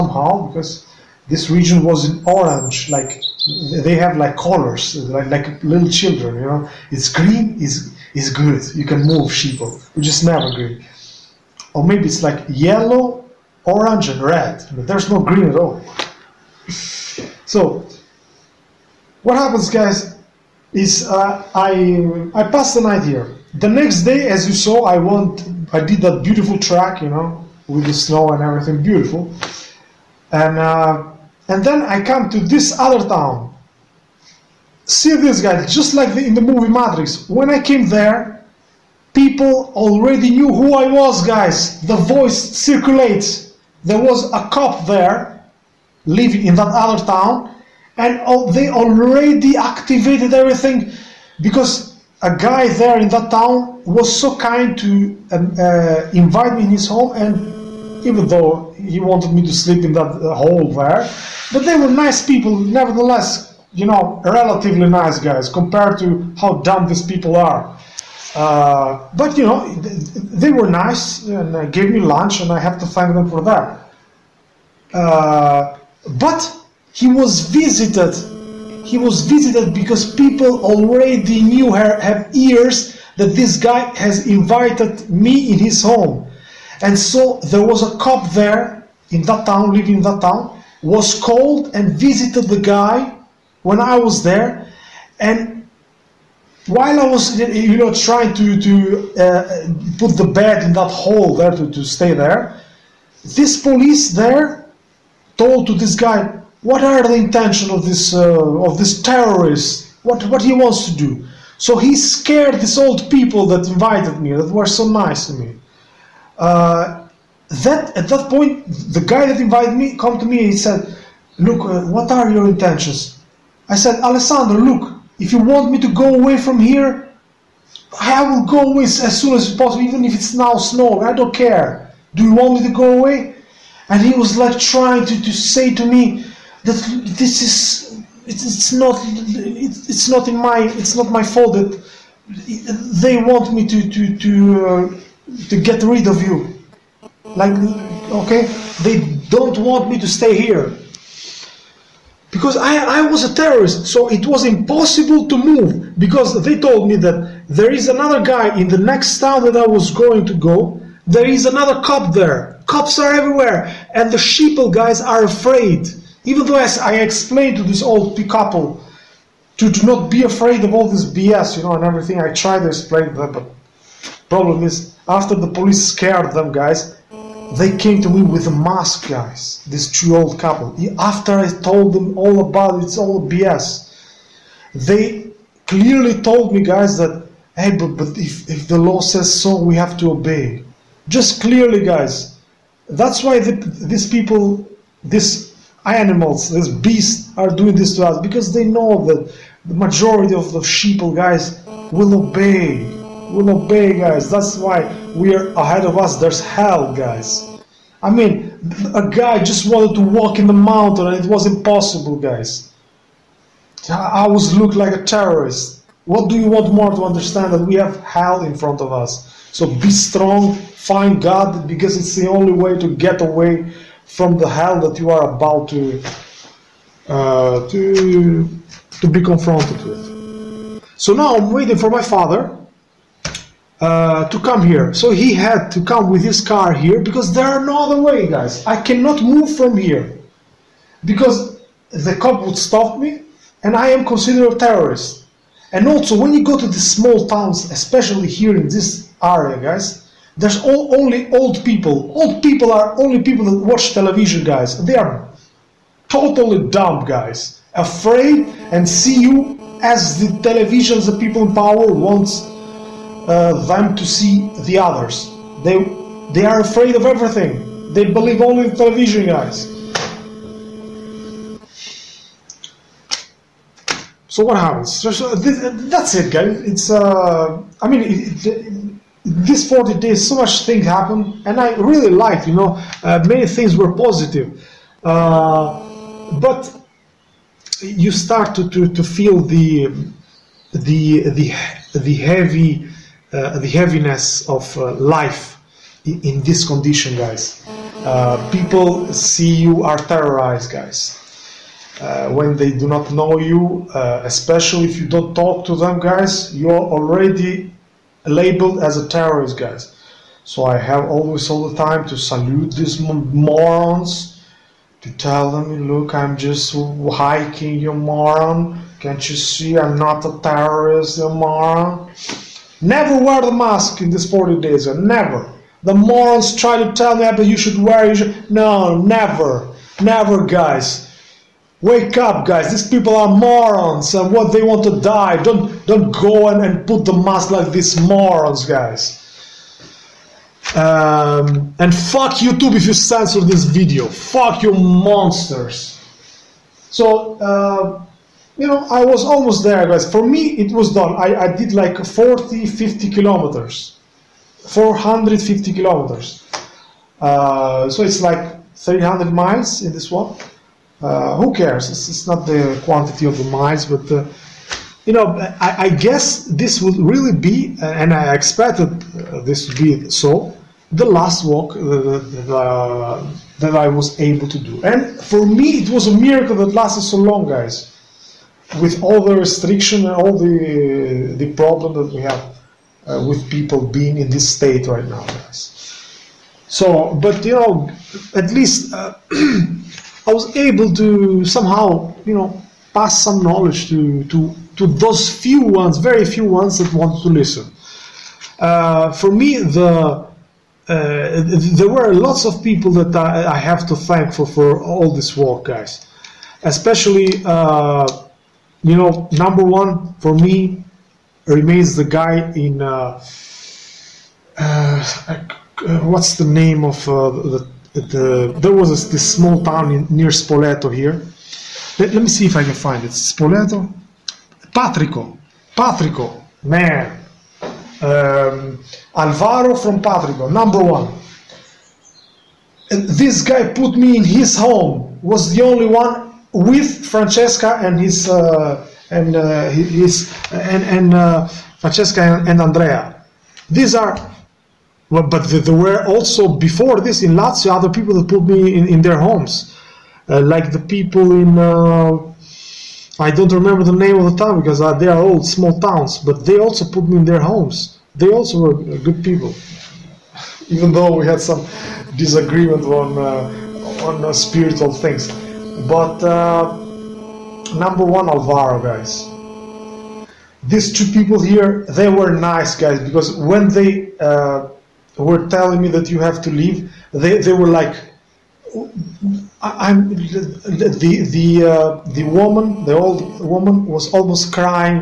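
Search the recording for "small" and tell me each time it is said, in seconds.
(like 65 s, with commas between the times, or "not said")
246 s, 419 s, 455 s.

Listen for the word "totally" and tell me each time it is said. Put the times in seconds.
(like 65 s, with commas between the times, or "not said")
256 s.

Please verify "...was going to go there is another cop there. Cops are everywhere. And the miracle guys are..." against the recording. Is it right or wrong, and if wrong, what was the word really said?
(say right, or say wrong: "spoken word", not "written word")
wrong: "sheeple", not "miracle".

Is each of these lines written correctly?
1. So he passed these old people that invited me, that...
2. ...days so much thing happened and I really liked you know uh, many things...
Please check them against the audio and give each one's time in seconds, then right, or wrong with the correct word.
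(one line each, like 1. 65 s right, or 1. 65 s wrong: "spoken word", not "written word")
1. 111 s wrong: "scared", not "passed"
2. 279 s right.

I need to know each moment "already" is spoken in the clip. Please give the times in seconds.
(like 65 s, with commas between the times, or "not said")
39 s, 48 s, 80 s, 306 s.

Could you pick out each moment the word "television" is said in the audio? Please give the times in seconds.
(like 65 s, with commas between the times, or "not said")
253 s, 260 s, 268 s.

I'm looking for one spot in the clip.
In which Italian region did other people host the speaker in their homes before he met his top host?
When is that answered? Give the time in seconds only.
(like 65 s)
447 s.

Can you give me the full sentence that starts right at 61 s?
But they were nice people, nevertheless, you know, relatively nice guys compared to how dumb these people are.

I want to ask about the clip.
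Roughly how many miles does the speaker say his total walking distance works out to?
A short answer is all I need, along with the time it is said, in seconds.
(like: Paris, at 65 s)
300 miles, at 358 s.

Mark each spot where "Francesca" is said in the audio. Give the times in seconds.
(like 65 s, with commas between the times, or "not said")
437 s, 441 s.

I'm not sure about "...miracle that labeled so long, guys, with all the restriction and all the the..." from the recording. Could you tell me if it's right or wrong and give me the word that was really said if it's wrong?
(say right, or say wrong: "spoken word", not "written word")
wrong: "lasted", not "labeled".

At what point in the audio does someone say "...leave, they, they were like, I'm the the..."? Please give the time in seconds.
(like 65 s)
476 s.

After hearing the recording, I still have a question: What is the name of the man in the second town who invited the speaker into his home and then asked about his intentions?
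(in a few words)
Alessandro.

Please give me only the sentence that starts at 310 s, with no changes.
So I have always all the time to salute these morons, to tell them, look, I'm just hiking, you moron.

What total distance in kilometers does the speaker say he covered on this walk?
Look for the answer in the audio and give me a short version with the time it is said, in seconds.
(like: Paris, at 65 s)
450 kilometers, at 354 s.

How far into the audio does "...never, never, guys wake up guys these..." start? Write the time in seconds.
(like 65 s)
328 s.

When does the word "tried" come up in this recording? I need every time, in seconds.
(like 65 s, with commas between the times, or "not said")
172 s.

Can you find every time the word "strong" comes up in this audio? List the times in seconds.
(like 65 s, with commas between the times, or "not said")
219 s.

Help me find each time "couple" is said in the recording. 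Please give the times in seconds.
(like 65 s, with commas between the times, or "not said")
168 s, 180 s.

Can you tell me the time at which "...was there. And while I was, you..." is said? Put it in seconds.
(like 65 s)
93 s.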